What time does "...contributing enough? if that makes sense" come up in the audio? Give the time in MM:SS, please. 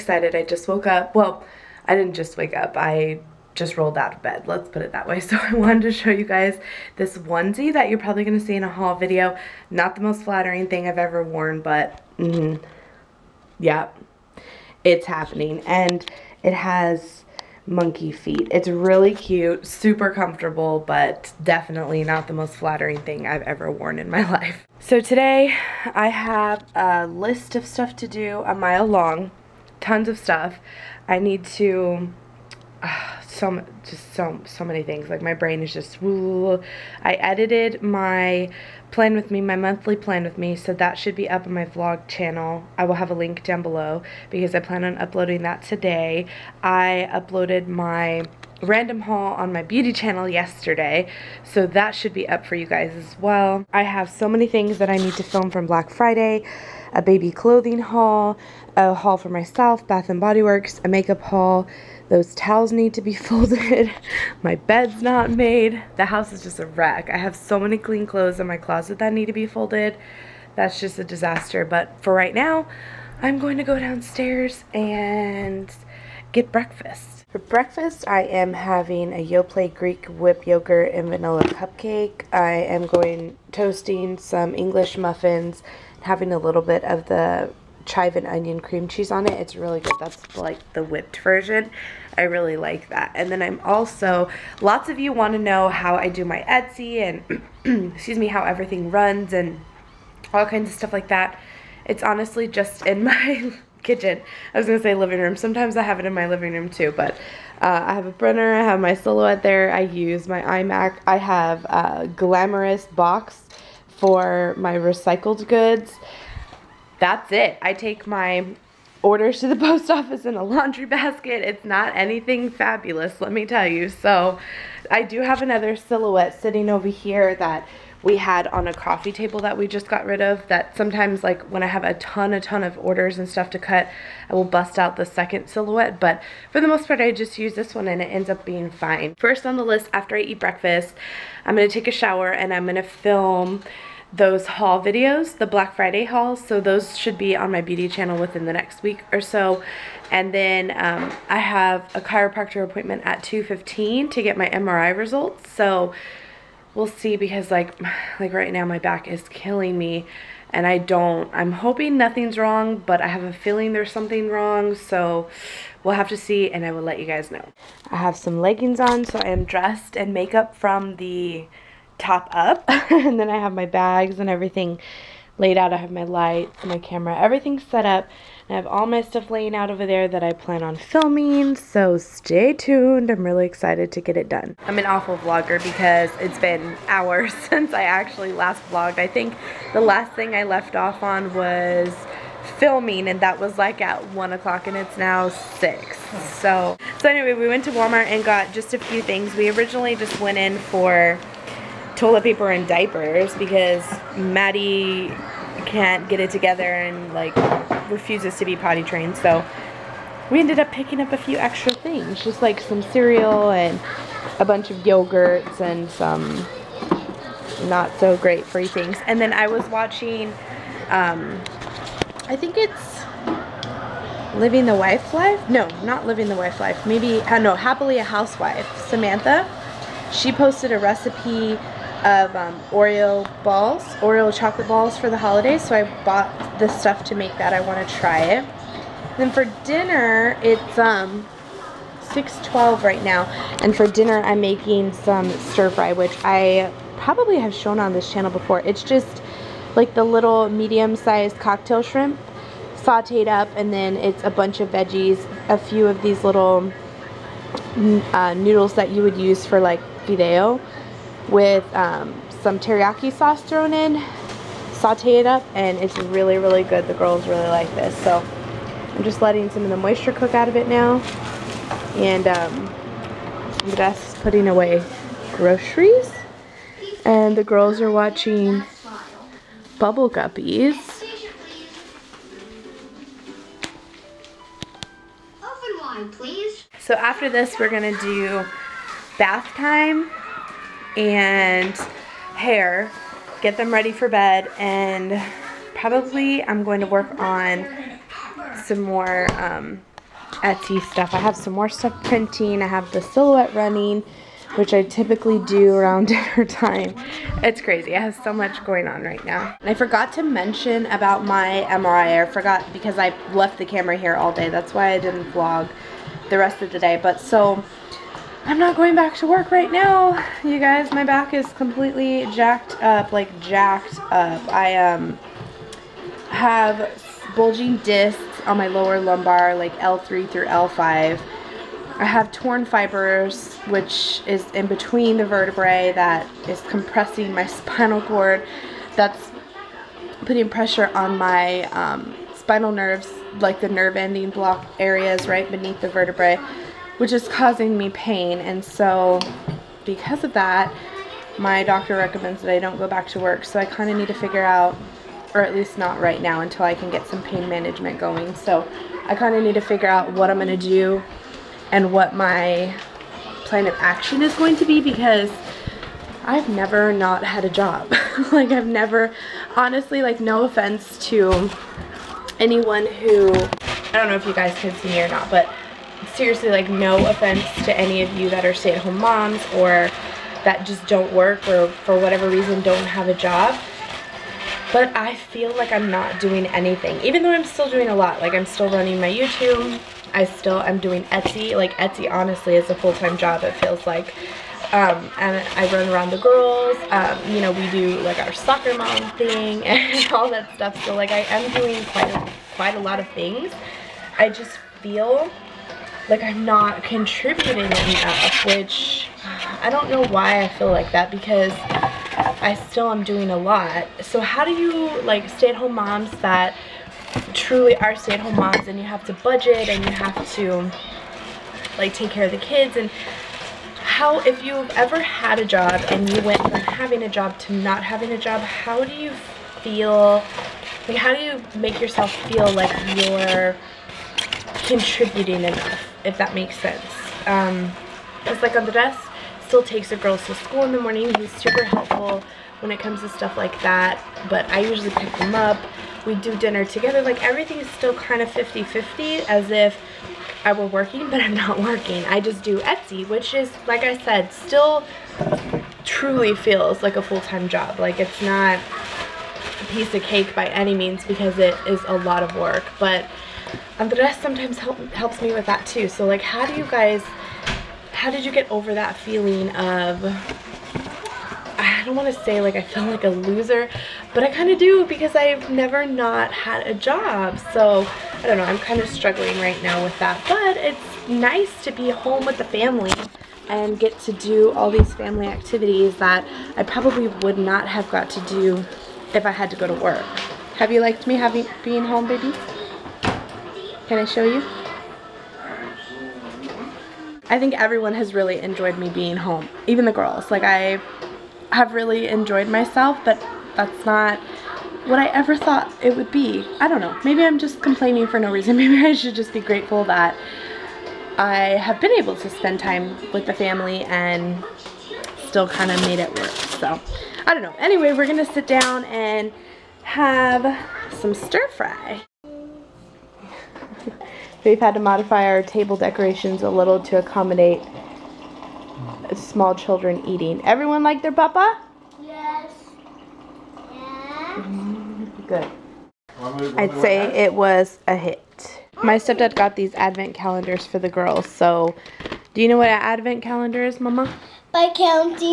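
07:14.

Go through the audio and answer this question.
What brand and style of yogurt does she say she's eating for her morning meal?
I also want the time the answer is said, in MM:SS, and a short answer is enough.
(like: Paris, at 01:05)
Yoplait Greek Whip, at 01:19.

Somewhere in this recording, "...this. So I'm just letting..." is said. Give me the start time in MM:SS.
04:27.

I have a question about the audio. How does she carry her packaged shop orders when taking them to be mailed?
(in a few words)
In a laundry basket.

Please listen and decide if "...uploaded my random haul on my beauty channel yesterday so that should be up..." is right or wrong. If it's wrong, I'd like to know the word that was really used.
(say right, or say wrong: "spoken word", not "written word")
right.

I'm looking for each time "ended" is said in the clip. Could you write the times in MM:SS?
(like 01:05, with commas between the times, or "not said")
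03:30.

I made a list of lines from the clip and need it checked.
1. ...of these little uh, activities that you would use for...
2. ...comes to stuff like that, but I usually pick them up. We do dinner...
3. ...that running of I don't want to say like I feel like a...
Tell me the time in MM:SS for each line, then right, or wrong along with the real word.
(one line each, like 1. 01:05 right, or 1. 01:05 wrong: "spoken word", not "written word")
1. 04:15 wrong: "noodles", not "activities"
2. 07:22 right
3. 07:48 wrong: "feeling", not "running".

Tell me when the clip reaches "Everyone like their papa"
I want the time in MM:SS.
08:50.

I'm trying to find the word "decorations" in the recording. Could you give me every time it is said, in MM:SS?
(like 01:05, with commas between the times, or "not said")
08:45.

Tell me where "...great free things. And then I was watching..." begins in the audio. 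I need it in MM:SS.
03:38.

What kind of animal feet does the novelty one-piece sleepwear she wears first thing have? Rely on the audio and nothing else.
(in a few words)
Monkey feet.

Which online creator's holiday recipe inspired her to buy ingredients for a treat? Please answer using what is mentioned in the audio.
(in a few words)
Happily a Housewife.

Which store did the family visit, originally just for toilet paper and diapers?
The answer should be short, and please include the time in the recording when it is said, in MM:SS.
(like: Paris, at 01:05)
Walmart, at 03:17.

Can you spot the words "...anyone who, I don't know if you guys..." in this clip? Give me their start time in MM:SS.
06:12.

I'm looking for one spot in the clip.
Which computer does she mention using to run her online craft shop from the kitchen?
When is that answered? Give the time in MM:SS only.
01:50.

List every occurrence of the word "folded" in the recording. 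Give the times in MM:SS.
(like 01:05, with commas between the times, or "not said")
01:03, 01:09.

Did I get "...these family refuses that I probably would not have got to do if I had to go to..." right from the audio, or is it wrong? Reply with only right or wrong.
wrong.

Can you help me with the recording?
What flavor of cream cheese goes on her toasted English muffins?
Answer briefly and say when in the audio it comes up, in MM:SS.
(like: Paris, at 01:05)
Chive and onion, at 01:27.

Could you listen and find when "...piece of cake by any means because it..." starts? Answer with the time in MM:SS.
07:39.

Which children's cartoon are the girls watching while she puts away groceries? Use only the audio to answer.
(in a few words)
Bubble Guppies.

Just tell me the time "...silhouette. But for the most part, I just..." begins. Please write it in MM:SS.
02:15.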